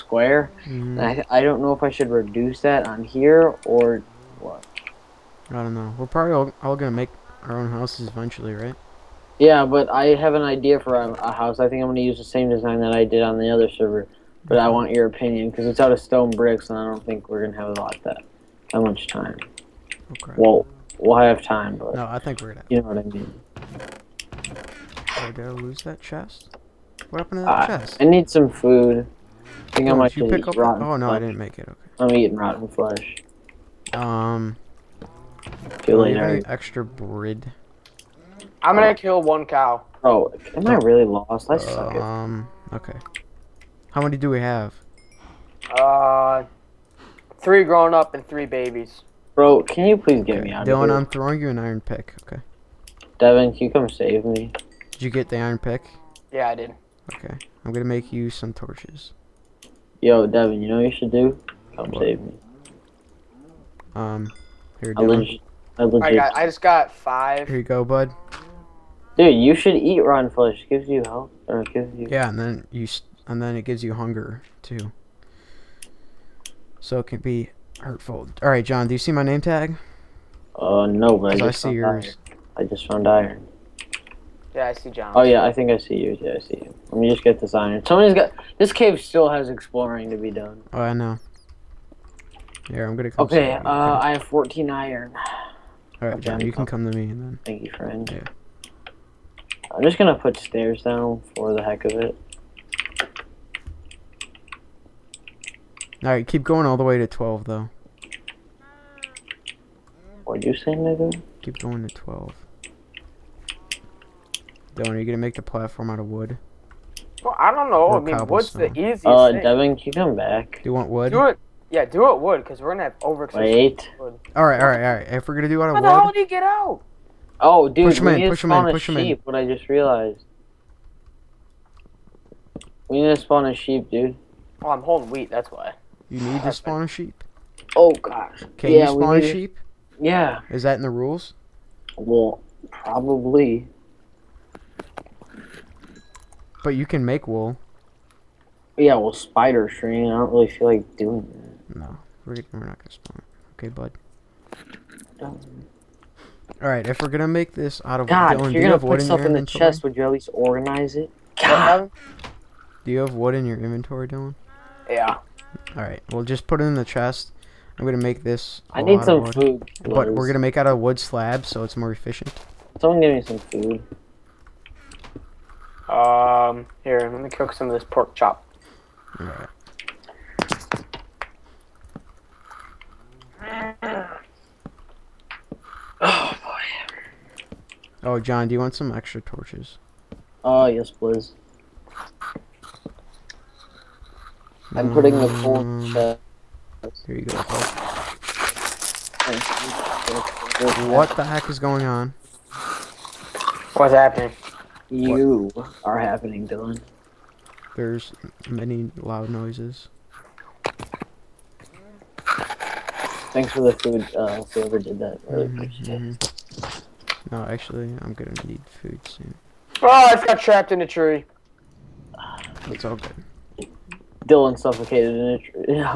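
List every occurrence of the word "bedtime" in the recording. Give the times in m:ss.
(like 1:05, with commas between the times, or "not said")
not said.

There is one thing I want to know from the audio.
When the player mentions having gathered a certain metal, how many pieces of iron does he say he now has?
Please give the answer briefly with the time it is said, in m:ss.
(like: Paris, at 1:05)
14, at 1:34.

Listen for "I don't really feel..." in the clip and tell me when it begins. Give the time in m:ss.
2:30.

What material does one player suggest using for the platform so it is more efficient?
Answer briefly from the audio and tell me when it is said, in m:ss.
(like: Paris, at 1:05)
wood slabs, at 2:50.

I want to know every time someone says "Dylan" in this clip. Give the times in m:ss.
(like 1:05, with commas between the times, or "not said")
0:50, 1:54, 2:38, 2:44, 3:26, 3:44.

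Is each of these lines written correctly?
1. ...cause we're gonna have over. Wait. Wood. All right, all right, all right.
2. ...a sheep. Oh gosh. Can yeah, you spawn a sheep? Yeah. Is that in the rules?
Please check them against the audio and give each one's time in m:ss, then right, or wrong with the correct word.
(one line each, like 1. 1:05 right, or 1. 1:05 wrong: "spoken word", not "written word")
1. 2:02 right
2. 2:16 right.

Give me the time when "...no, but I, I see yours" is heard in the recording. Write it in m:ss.
1:20.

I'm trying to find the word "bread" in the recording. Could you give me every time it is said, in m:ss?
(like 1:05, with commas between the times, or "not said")
0:36.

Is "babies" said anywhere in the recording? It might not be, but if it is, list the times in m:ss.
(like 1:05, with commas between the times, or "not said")
0:48.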